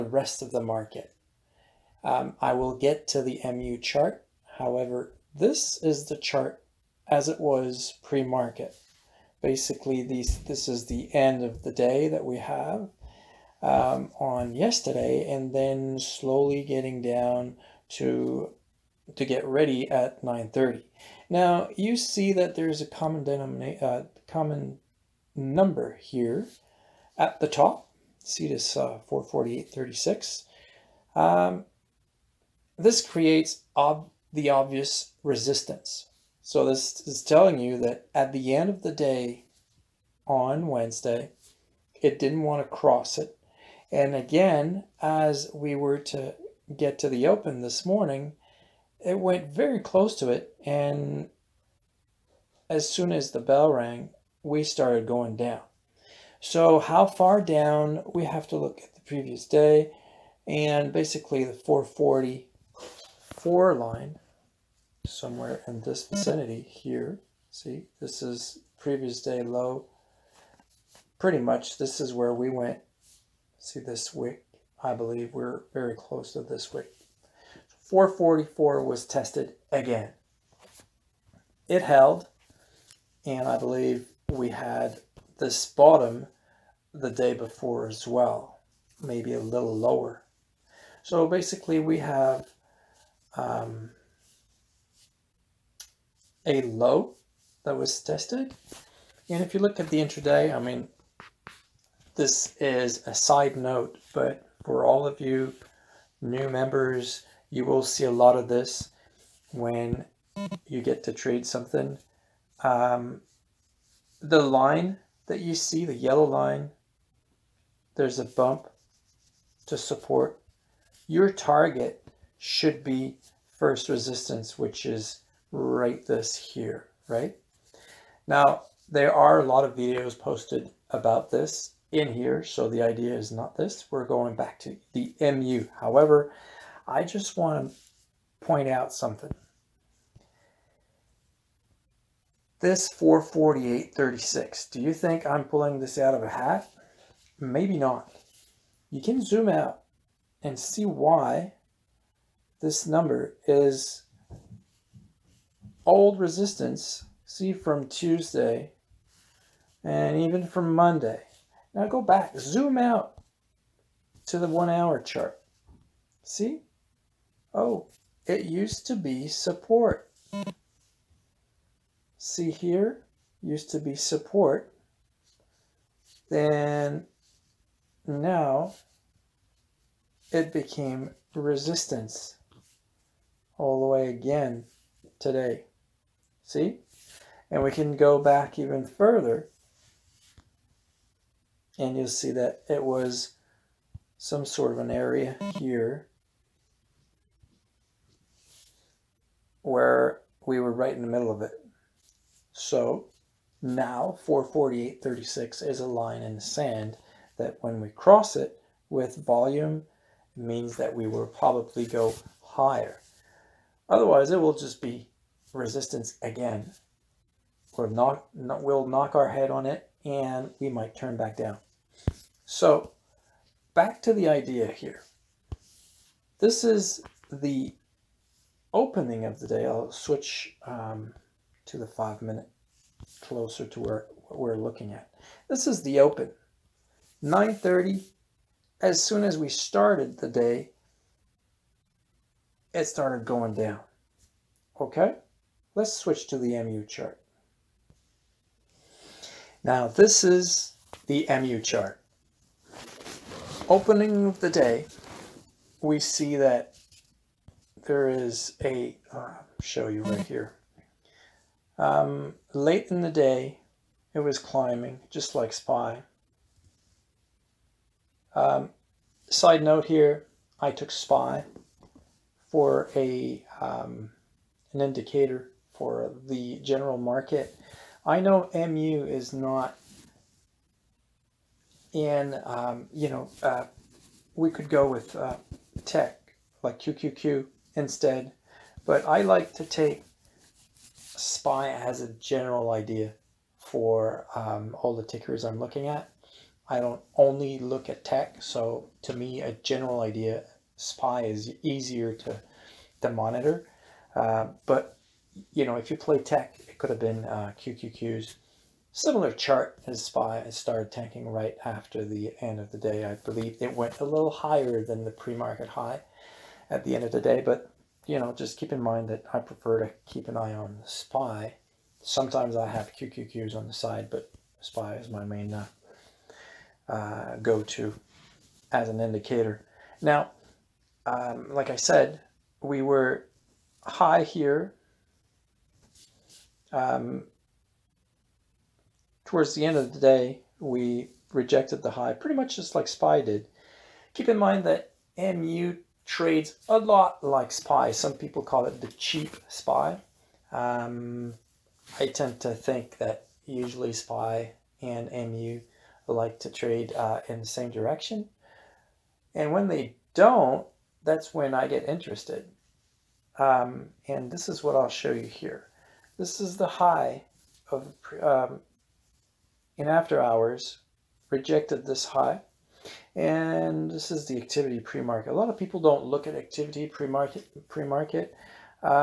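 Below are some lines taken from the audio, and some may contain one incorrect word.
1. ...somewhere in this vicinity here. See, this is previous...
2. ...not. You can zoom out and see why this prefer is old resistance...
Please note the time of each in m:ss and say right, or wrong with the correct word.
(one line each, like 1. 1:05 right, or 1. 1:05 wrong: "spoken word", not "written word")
1. 1:05 right
2. 2:27 wrong: "number", not "prefer".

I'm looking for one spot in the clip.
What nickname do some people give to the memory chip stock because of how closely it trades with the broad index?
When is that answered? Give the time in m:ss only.
5:48.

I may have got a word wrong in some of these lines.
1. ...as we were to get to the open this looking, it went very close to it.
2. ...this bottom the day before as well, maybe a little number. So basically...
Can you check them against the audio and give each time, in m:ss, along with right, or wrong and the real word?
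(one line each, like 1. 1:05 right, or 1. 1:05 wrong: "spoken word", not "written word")
1. 0:44 wrong: "morning", not "looking"
2. 1:25 wrong: "lower", not "number".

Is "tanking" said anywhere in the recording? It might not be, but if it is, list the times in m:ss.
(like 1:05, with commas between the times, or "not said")
5:10.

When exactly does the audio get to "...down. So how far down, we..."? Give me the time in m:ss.
0:55.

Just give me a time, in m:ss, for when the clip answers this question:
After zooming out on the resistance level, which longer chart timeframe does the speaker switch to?
2:44.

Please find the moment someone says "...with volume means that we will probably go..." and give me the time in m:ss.
3:28.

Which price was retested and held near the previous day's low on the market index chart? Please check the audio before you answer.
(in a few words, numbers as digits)
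444.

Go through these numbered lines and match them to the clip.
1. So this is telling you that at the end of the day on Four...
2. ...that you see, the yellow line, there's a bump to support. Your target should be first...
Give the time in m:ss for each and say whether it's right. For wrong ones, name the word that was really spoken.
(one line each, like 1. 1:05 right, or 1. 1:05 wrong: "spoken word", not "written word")
1. 0:36 wrong: "Wednesday", not "Four"
2. 1:55 right.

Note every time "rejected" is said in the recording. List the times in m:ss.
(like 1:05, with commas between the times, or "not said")
5:41, 6:11.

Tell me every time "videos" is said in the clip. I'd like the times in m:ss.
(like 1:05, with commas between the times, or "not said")
2:09.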